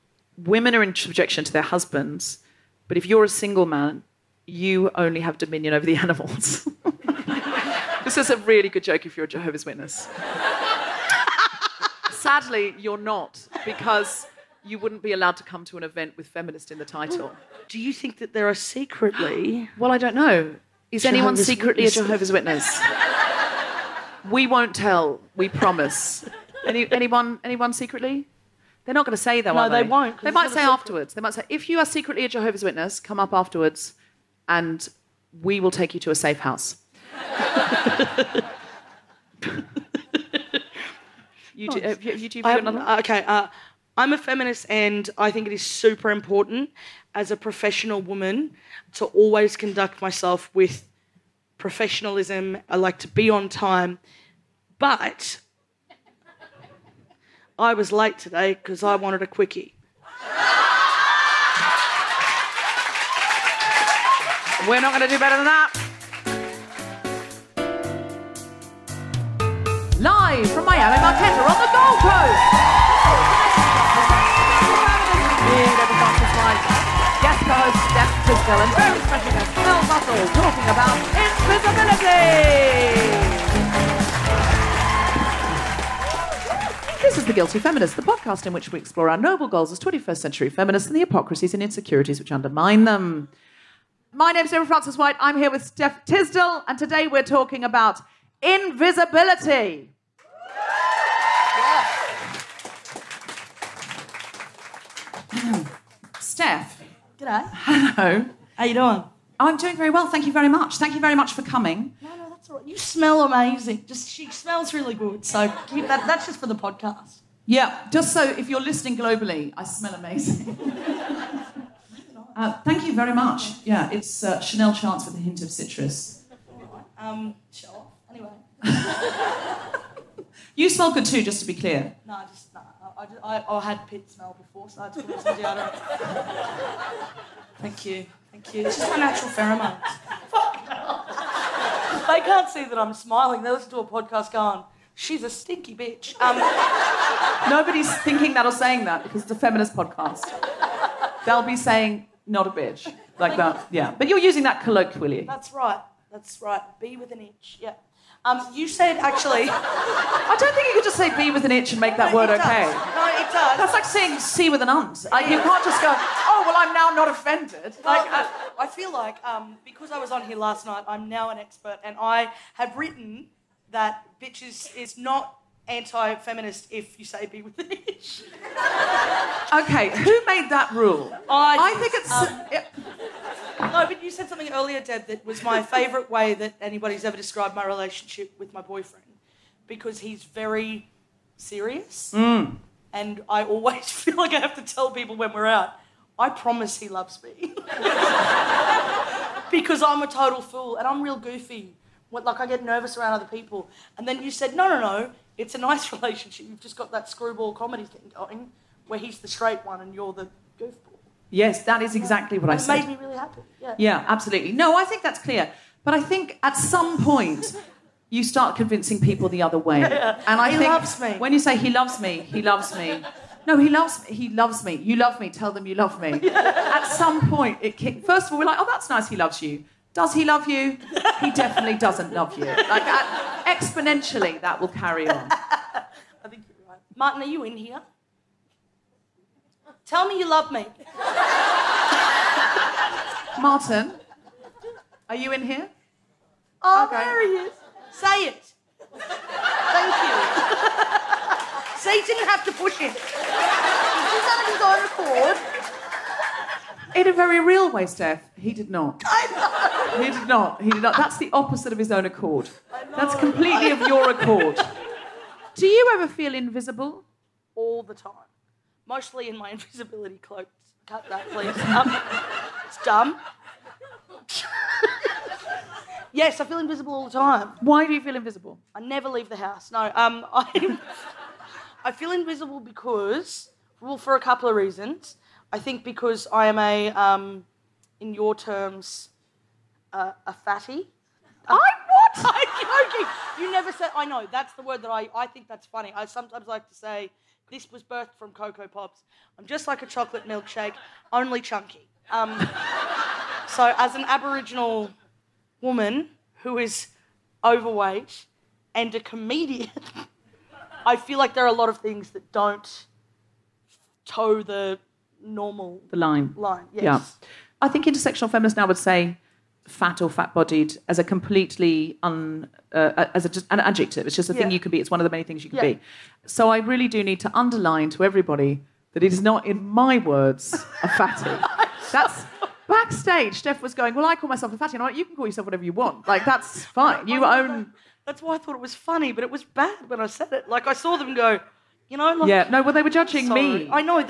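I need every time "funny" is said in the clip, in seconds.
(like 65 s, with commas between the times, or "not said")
295 s, 338 s.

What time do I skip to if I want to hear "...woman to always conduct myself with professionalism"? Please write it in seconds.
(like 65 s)
47 s.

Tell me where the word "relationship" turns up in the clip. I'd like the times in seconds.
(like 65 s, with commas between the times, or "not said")
187 s, 205 s.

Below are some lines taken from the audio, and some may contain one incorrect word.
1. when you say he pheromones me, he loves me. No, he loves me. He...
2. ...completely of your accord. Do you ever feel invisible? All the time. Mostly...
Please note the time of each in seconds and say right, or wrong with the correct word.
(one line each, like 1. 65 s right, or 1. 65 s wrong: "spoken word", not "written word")
1. 221 s wrong: "loves", not "pheromones"
2. 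263 s right.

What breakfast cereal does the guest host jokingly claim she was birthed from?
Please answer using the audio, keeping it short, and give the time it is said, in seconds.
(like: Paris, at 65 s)
Coco Pops, at 298 s.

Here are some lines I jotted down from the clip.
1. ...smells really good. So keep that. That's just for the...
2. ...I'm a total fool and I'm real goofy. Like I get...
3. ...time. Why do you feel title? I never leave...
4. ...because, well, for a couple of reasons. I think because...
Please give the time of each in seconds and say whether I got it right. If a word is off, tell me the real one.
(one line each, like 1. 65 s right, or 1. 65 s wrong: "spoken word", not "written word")
1. 114 s right
2. 199 s right
3. 277 s wrong: "invisible", not "title"
4. 282 s right.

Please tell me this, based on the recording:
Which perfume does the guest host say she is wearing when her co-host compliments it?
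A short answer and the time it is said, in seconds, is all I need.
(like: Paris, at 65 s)
Chanel Chance, at 124 s.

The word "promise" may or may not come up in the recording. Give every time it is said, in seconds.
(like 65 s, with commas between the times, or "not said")
25 s, 196 s.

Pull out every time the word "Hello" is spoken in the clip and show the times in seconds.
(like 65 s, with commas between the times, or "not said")
107 s.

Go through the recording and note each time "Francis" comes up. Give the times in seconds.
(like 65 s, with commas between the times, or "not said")
94 s.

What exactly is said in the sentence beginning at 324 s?
thing you can be it's one of the many things you can yeah.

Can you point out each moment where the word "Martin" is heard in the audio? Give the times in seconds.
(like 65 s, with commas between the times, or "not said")
236 s, 243 s.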